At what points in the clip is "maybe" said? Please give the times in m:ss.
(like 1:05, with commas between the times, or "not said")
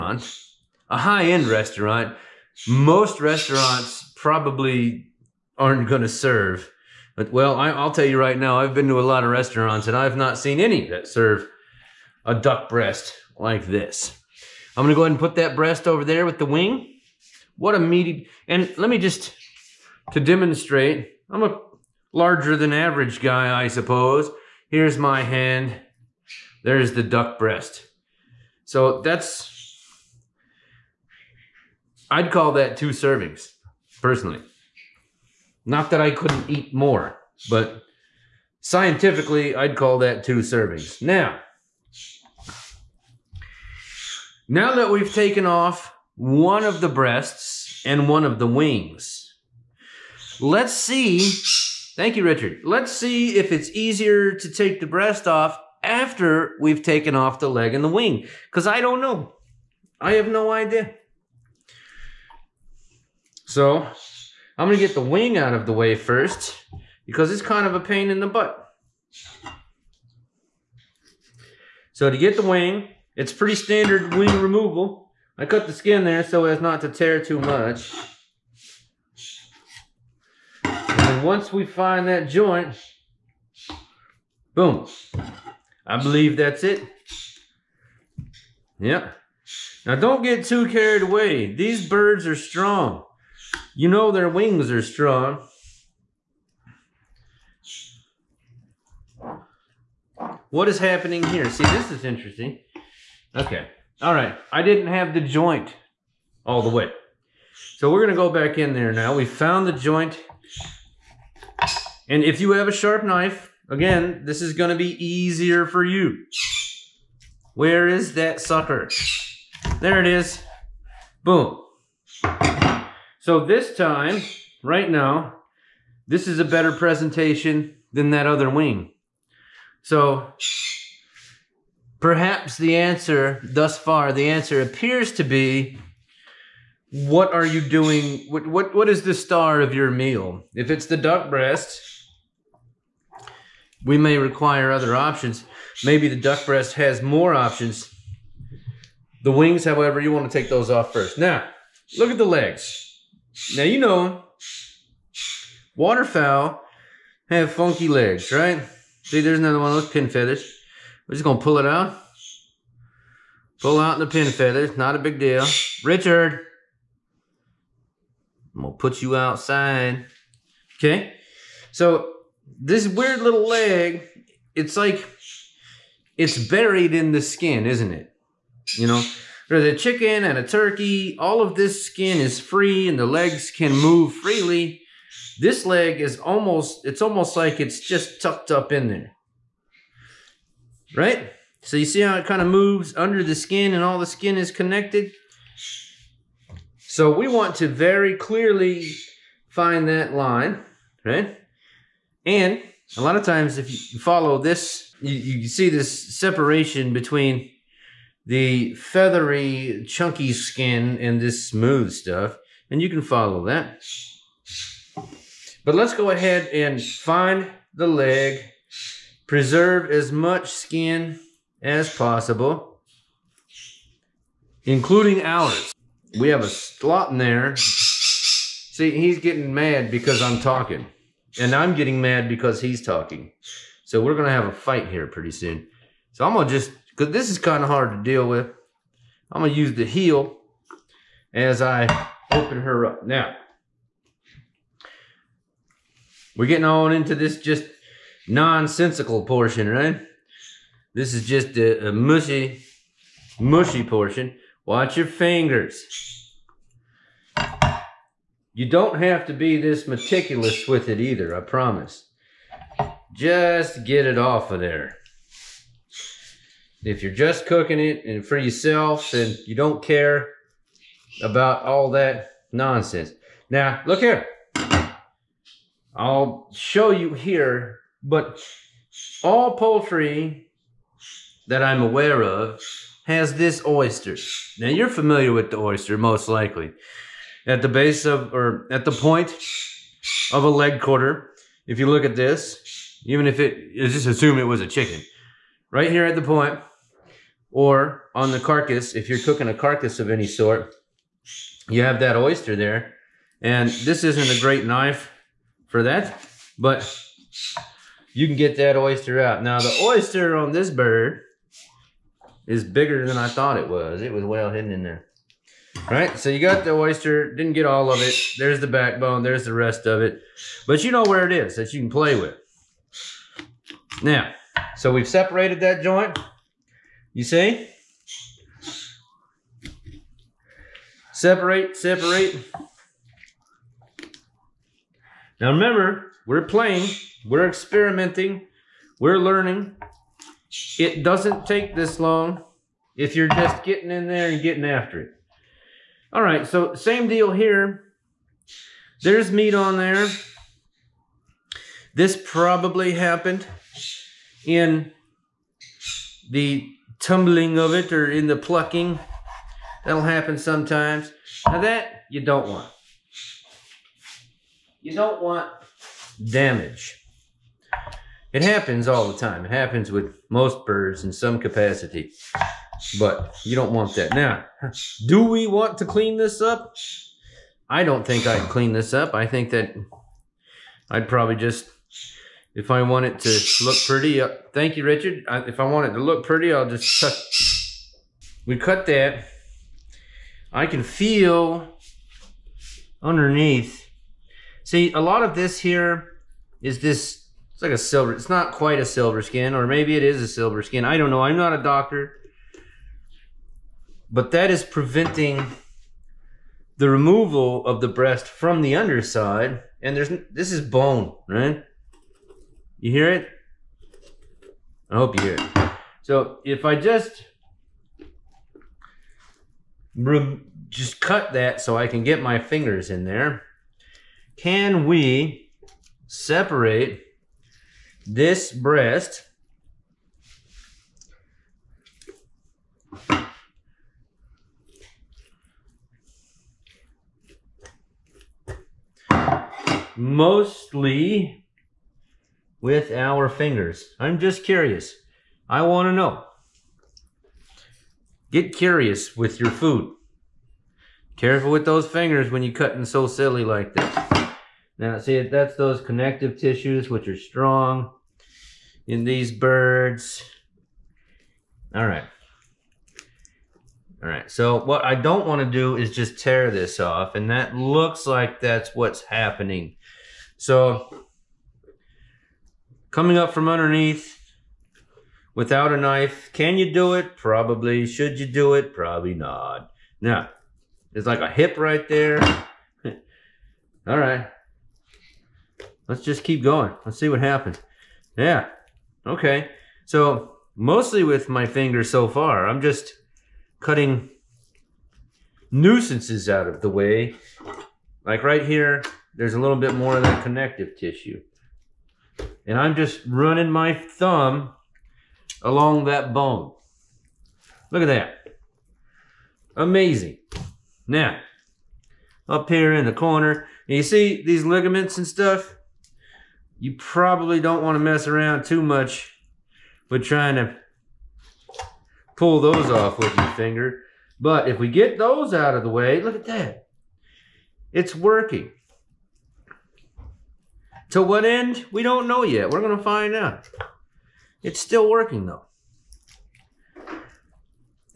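2:25, 6:39.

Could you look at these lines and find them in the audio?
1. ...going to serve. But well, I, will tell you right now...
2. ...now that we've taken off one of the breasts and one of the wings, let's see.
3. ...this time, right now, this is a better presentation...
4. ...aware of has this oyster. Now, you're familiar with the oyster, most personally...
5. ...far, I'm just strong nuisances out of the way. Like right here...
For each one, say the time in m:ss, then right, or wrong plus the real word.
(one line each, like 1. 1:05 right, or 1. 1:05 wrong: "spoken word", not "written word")
1. 0:05 right
2. 0:44 right
3. 2:03 right
4. 4:41 wrong: "likely", not "personally"
5. 8:12 wrong: "cutting", not "strong".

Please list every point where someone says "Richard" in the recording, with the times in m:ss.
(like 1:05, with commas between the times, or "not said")
0:52, 2:45, 6:24.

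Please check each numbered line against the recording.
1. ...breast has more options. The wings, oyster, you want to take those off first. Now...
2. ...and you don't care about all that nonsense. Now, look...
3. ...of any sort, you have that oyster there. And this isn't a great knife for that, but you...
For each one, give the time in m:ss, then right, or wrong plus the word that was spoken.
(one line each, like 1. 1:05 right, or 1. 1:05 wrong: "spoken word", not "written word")
1. 2:26 wrong: "however", not "oyster"
2. 4:29 right
3. 4:59 right.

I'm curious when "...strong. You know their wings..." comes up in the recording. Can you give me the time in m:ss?
1:32.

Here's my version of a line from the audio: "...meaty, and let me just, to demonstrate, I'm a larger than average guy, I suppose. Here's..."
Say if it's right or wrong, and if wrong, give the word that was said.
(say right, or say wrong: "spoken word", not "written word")
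right.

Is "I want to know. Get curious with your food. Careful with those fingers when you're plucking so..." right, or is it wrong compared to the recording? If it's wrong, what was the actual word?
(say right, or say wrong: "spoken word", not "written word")
wrong: "cutting", not "plucking".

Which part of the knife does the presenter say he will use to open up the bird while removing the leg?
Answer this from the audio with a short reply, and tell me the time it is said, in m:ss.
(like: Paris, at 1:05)
The heel, at 3:59.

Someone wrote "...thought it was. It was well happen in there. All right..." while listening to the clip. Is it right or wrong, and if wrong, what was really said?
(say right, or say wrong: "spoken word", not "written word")
wrong: "hidden", not "happen".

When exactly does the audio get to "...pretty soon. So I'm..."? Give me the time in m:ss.
3:55.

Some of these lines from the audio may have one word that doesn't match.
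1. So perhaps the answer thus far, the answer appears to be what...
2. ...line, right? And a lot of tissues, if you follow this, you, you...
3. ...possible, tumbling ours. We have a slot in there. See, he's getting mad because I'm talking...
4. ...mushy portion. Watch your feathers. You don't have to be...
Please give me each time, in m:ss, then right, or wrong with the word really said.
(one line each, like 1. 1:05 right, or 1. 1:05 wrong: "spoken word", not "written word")
1. 2:09 right
2. 3:20 wrong: "times", not "tissues"
3. 3:41 wrong: "including", not "tumbling"
4. 4:13 wrong: "fingers", not "feathers".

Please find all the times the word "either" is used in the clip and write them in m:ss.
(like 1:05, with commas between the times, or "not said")
4:20.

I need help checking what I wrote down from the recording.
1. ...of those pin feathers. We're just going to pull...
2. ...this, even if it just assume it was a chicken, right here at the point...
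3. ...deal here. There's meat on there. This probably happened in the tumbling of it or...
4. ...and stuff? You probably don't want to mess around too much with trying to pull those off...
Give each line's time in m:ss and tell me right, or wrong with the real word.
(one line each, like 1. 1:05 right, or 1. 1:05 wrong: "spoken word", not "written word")
1. 2:39 right
2. 4:52 right
3. 5:47 right
4. 8:34 right.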